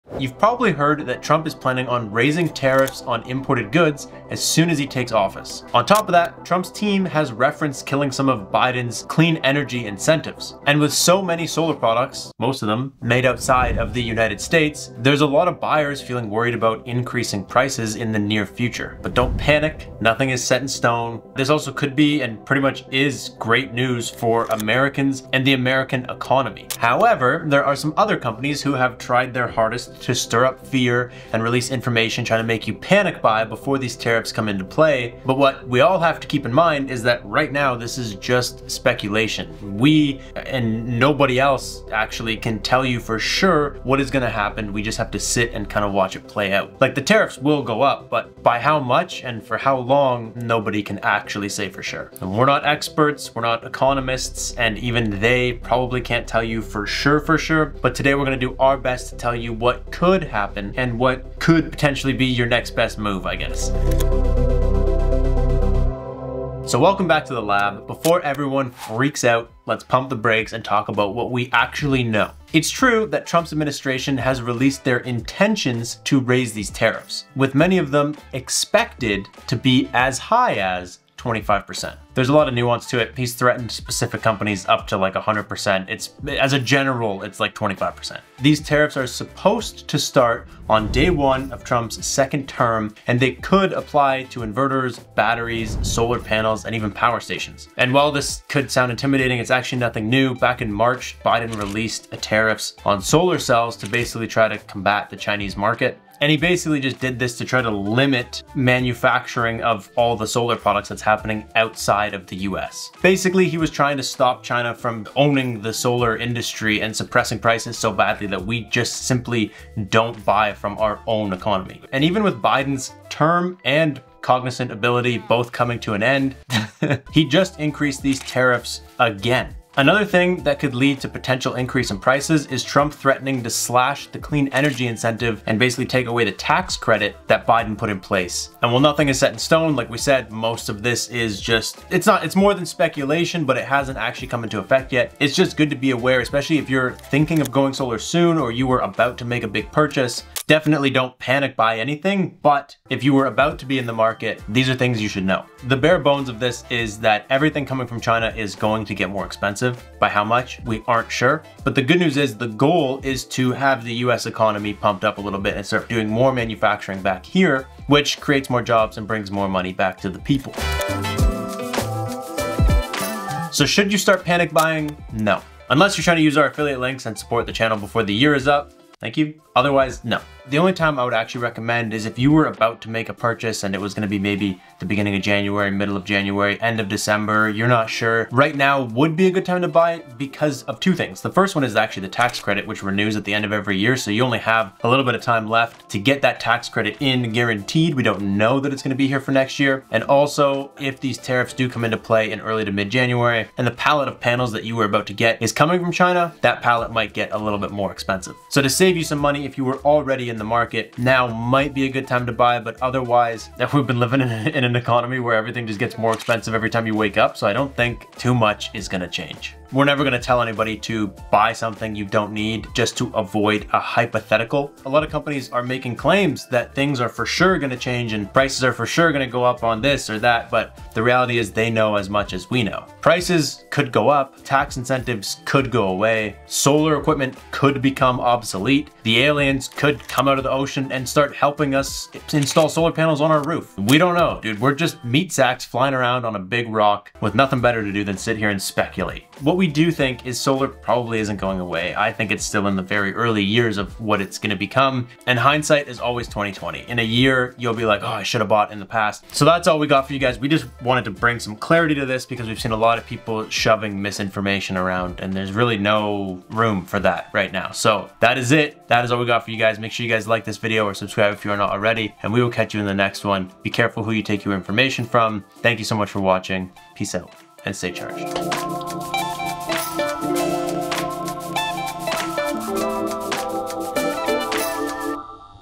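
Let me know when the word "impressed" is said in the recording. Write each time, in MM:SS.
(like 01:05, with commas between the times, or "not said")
not said.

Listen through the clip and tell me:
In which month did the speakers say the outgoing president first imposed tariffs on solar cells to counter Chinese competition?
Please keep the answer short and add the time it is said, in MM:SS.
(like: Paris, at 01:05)
March, at 01:40.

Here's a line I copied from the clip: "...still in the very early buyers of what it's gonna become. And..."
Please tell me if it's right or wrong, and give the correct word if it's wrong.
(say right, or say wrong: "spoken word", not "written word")
wrong: "years", not "buyers".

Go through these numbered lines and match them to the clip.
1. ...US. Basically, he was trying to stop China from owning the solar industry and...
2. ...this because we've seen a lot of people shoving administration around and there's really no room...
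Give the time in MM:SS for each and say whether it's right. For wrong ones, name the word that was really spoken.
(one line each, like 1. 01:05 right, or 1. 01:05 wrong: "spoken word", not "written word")
1. 01:52 right
2. 04:22 wrong: "misinformation", not "administration".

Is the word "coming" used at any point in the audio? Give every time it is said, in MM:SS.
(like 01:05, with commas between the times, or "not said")
02:05, 02:37, 03:25.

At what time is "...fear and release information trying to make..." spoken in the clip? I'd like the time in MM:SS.
00:30.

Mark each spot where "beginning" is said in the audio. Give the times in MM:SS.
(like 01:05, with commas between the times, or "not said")
03:04.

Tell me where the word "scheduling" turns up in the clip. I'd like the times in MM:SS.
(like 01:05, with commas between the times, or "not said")
not said.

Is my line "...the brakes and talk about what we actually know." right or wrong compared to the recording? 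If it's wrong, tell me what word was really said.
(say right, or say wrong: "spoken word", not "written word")
right.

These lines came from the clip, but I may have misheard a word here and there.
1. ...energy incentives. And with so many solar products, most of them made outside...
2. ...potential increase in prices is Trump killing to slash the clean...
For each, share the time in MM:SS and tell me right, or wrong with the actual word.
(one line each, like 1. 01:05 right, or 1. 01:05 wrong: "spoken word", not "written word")
1. 00:09 right
2. 02:11 wrong: "threatening", not "killing".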